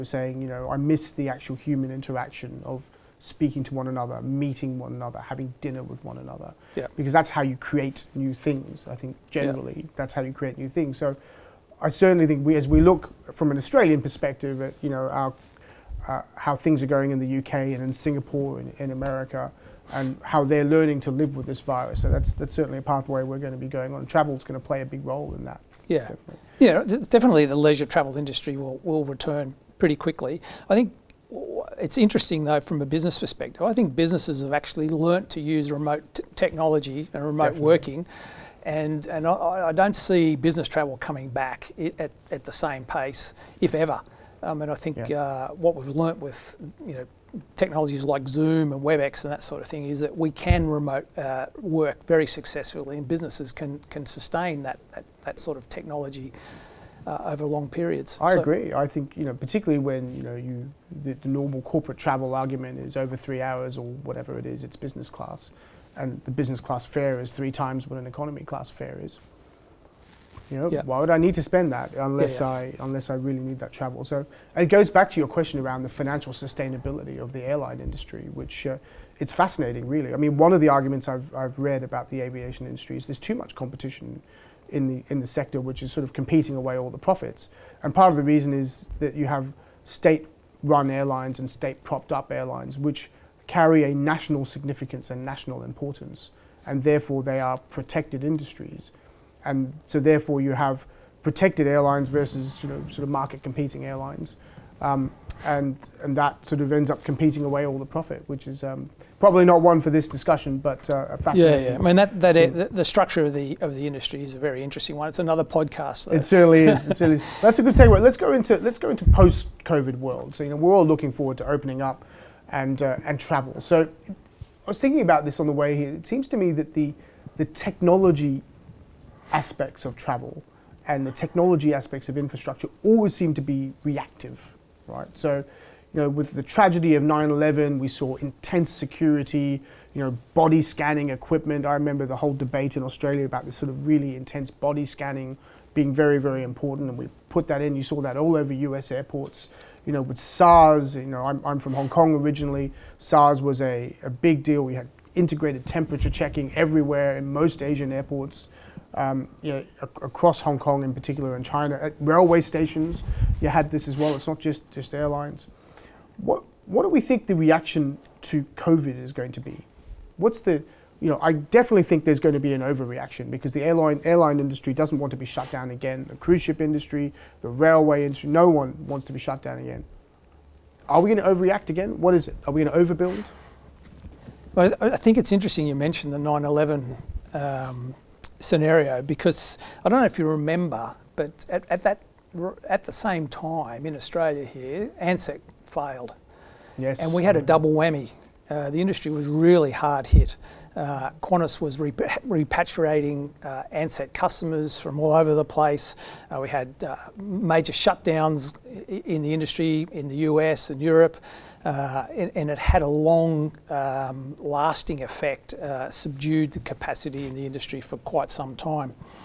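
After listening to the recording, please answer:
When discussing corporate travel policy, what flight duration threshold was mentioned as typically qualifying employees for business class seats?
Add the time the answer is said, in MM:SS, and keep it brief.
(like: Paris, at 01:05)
3 hours, at 01:03.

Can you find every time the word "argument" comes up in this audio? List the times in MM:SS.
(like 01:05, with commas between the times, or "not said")
01:02, 01:20.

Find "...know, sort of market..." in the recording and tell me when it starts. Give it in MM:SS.
01:42.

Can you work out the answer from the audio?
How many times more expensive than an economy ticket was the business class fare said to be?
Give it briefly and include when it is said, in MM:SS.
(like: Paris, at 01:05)
3 times, at 01:07.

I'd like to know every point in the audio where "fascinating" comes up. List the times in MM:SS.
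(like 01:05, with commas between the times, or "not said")
01:19, 01:51.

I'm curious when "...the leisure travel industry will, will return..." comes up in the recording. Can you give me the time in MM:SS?
00:27.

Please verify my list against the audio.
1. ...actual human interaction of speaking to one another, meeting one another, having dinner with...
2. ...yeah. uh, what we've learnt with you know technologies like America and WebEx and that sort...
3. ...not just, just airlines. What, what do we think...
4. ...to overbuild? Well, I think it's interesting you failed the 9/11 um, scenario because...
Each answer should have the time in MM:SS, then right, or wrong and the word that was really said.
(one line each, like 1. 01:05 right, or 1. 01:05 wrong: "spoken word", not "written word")
1. 00:01 right
2. 00:45 wrong: "Zoom", not "America"
3. 02:44 right
4. 03:02 wrong: "mentioned", not "failed".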